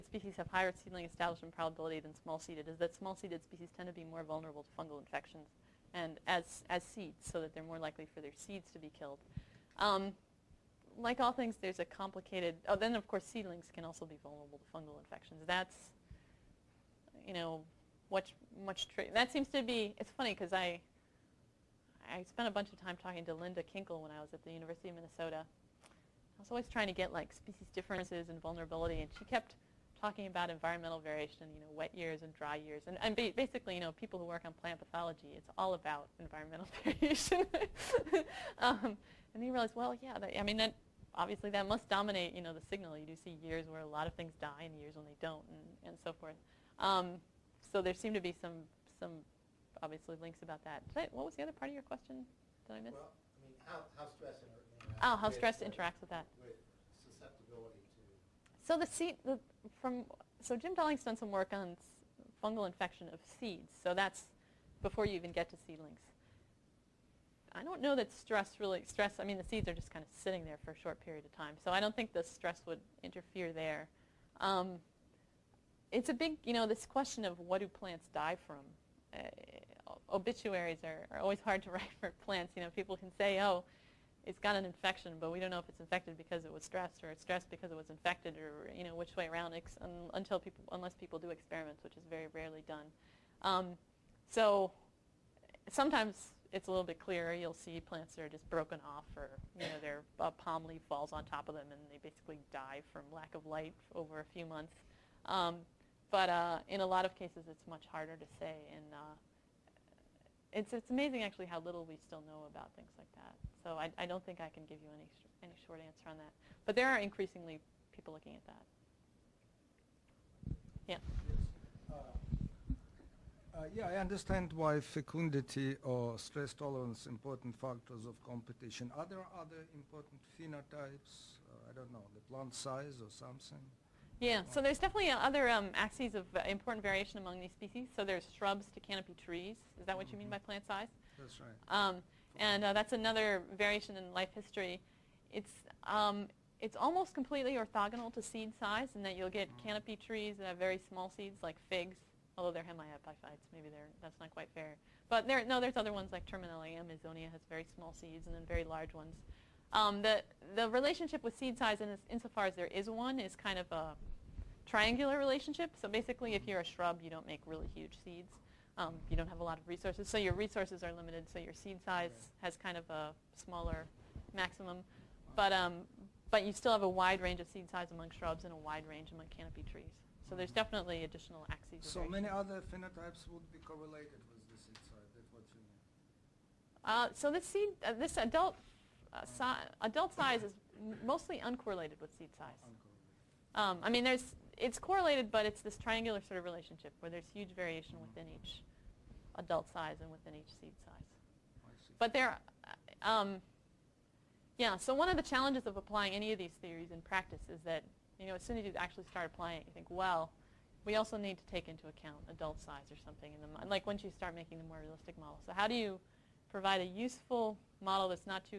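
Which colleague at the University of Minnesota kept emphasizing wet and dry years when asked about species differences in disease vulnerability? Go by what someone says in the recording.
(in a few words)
Linda Kinkel.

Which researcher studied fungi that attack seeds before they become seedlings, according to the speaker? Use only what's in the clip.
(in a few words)
Jim Dalling.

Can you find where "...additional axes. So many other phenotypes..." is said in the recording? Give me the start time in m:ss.
3:01.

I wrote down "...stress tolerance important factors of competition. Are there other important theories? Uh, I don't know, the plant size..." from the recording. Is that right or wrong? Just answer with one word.
wrong.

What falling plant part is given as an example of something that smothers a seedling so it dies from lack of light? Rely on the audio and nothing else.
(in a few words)
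Palm leaf.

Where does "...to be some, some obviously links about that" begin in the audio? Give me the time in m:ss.
0:48.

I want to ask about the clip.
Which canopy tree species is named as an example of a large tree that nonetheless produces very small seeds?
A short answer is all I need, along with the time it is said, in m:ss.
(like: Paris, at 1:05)
Terminalia amazonia, at 2:36.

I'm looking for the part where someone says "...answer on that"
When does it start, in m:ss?
1:55.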